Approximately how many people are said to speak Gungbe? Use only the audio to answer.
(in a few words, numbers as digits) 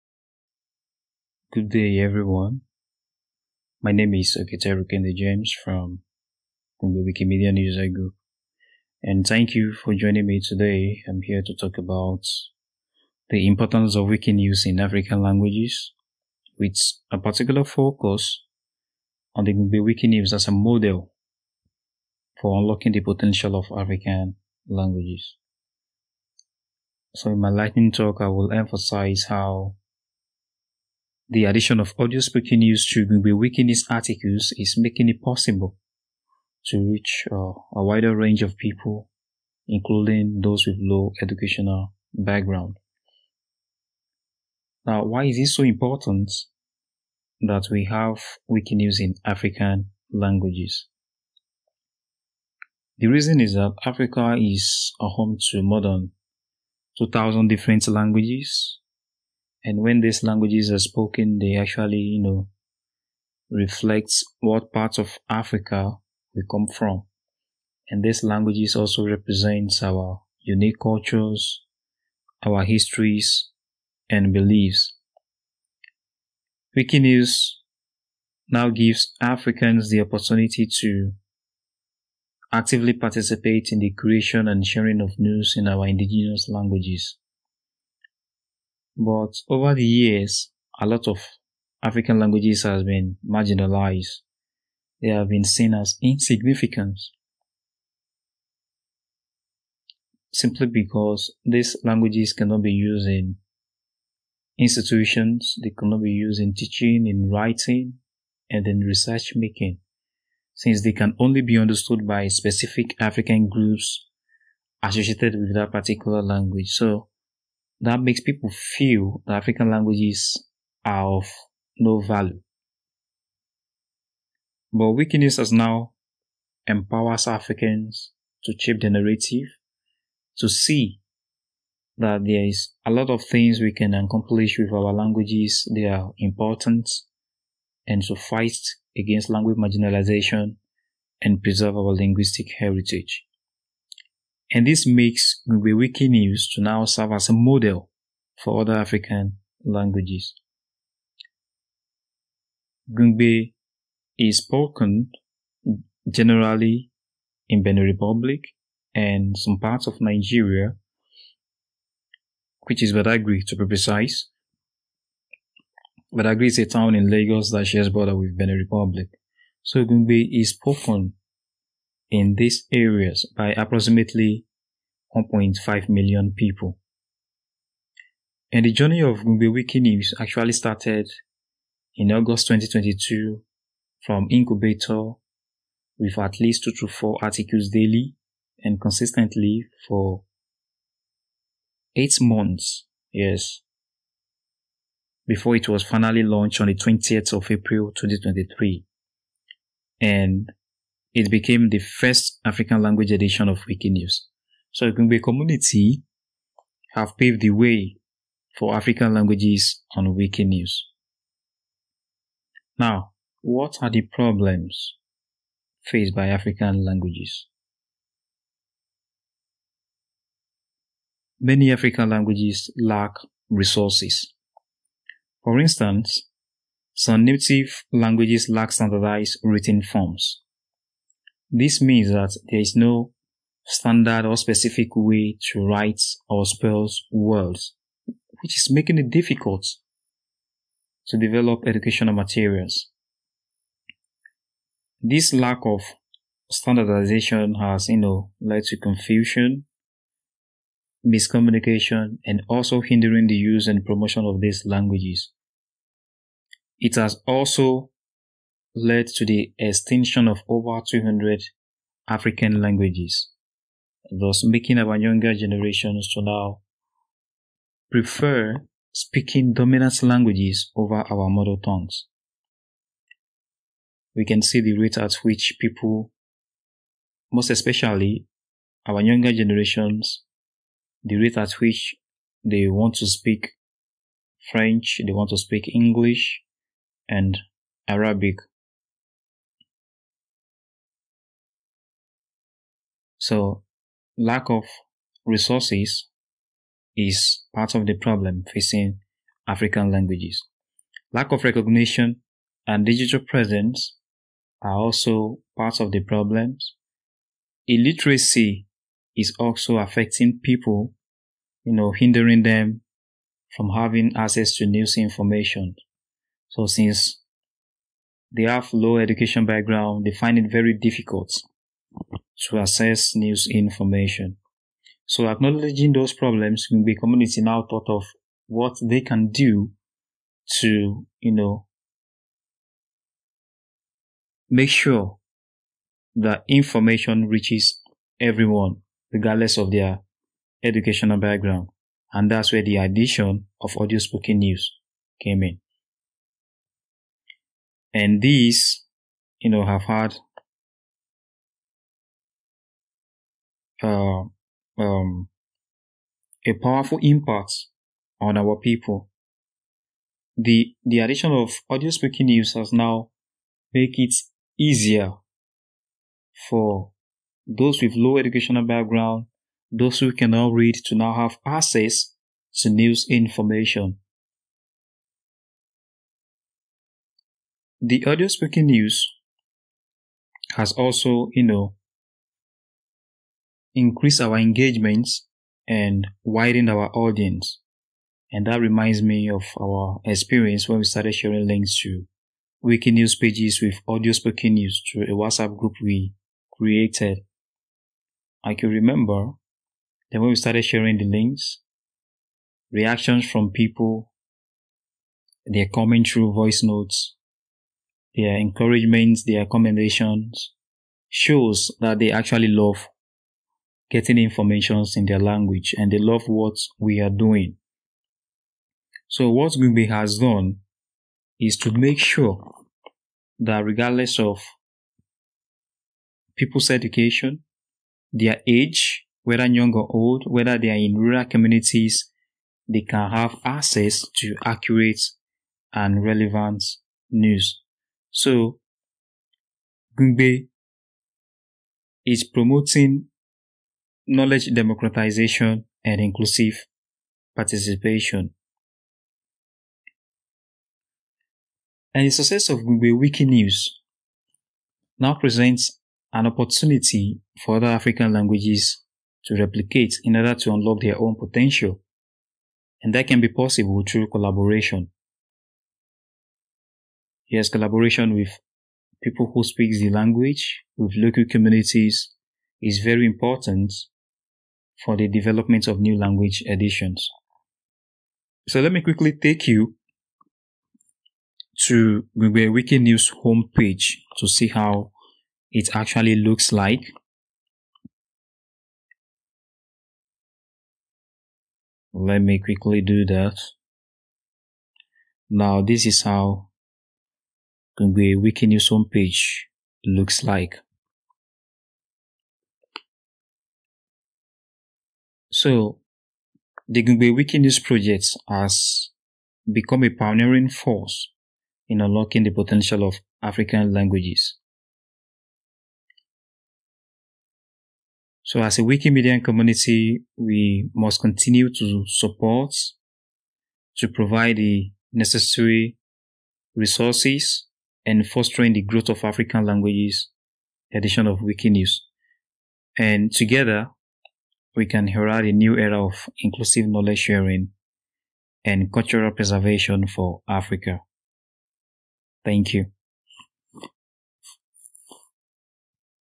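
1.5 million.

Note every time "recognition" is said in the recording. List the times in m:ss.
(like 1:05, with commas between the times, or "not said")
5:01.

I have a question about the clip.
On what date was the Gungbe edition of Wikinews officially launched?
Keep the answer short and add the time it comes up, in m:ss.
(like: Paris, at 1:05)
20 April 2023, at 3:16.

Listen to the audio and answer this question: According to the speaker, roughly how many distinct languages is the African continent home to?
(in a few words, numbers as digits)
more than 2,000.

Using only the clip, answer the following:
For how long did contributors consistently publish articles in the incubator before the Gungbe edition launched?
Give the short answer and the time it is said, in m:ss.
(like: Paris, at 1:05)
eight months, at 3:11.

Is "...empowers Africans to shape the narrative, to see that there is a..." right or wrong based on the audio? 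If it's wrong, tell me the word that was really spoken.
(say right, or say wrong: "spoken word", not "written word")
right.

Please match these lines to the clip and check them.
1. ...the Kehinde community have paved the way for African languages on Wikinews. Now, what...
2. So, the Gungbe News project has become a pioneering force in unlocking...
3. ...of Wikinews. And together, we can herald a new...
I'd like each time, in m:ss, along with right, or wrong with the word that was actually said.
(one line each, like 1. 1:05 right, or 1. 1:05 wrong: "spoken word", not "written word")
1. 3:24 wrong: "Igungbe", not "Kehinde"
2. 8:25 right
3. 8:51 right.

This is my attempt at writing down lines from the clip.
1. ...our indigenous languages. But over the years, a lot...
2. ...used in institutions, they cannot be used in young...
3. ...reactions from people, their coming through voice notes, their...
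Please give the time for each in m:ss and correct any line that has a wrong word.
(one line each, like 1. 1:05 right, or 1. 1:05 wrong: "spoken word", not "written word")
1. 1:25 right
2. 1:42 wrong: "teaching", not "young"
3. 6:42 right.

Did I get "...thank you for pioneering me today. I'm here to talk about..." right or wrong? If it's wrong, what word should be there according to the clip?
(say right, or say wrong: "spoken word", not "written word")
wrong: "joining", not "pioneering".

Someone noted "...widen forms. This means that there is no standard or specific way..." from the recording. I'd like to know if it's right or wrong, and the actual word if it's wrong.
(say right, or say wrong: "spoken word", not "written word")
wrong: "written", not "widen".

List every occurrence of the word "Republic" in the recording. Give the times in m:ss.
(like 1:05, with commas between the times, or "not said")
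2:37, 2:48.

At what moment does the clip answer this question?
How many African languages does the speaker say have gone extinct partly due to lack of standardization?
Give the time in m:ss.
4:20.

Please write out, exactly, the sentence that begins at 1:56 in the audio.
So that makes people feel that African languages are of no value.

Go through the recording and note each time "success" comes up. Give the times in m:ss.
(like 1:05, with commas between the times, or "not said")
7:32.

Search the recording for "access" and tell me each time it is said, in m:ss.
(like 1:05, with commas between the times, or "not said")
5:14, 5:22, 6:11, 7:13.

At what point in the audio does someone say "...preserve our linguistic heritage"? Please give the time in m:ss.
2:21.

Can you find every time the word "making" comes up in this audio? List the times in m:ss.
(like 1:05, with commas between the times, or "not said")
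0:34, 1:49, 3:58, 4:24.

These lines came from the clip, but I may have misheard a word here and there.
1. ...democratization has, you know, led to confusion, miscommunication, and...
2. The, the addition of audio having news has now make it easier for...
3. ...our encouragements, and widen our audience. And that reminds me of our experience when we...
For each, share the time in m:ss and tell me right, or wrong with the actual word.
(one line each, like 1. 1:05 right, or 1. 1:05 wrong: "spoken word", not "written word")
1. 4:06 wrong: "standardization", not "democratization"
2. 6:00 wrong: "speaking", not "having"
3. 6:24 wrong: "engagements", not "encouragements".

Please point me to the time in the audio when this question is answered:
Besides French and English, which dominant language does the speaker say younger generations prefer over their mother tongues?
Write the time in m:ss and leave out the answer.
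4:47.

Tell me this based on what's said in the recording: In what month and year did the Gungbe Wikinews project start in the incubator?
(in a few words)
August 2022.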